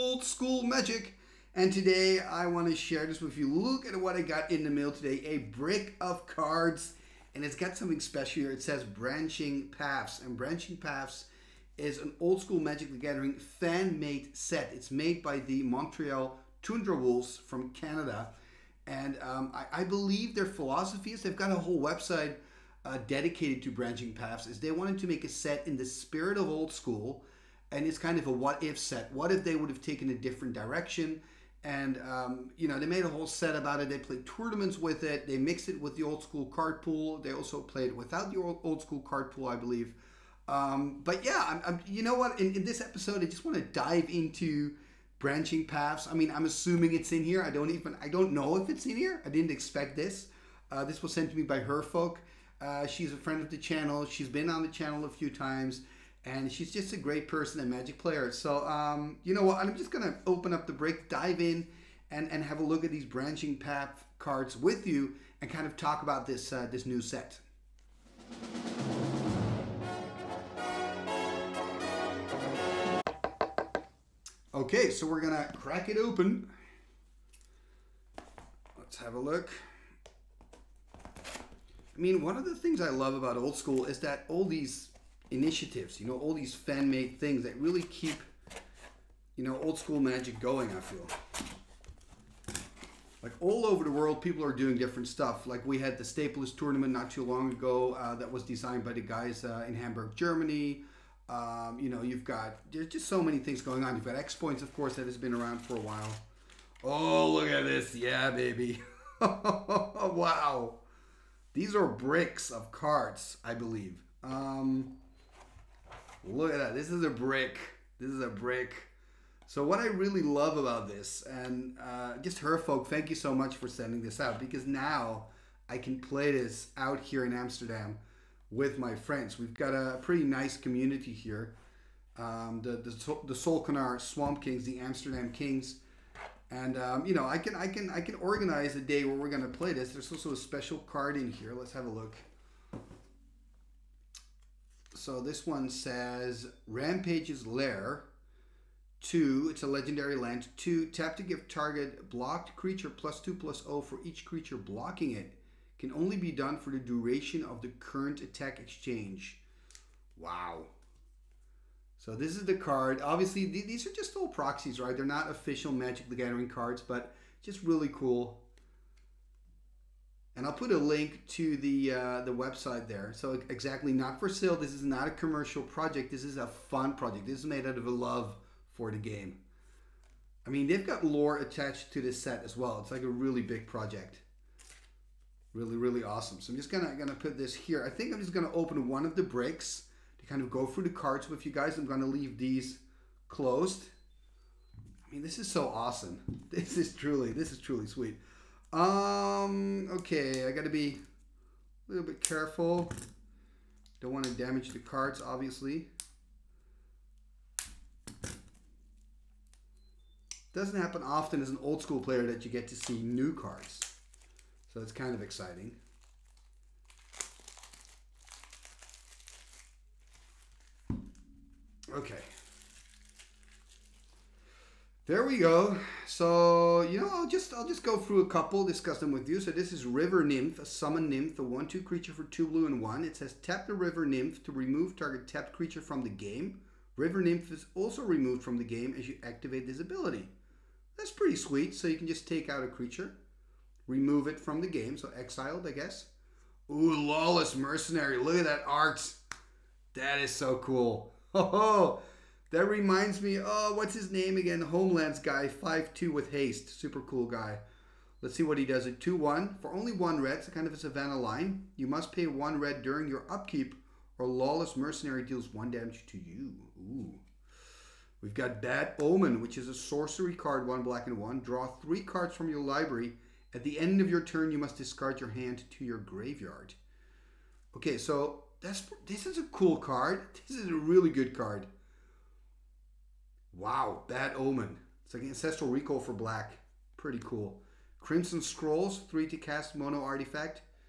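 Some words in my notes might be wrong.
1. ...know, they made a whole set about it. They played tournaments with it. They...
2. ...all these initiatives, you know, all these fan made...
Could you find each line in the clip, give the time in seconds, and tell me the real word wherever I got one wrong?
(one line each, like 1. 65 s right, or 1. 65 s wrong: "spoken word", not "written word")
1. 32 s right
2. 84 s right.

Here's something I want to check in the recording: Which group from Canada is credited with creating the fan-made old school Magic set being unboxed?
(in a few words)
Montreal Tundra Wolves.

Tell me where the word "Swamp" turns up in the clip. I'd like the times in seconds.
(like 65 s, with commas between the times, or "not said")
134 s.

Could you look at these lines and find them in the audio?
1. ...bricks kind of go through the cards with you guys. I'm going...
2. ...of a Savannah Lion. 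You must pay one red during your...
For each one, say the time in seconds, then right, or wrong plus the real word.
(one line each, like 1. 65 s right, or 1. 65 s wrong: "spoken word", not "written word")
1. 189 s right
2. 260 s right.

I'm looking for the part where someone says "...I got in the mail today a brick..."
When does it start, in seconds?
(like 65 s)
4 s.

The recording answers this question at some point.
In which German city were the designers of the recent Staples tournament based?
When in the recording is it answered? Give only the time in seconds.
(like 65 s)
99 s.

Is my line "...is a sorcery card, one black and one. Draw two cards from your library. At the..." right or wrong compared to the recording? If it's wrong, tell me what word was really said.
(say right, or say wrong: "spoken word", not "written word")
wrong: "three", not "two".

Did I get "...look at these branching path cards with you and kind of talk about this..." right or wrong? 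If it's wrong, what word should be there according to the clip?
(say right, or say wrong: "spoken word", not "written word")
right.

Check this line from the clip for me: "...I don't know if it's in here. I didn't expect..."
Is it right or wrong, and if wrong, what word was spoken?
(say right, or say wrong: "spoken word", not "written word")
right.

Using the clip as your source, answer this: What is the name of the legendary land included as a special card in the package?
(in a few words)
Rampage's Lair.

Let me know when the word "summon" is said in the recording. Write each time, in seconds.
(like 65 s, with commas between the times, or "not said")
230 s.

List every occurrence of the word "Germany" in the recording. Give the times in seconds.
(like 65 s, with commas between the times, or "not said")
100 s.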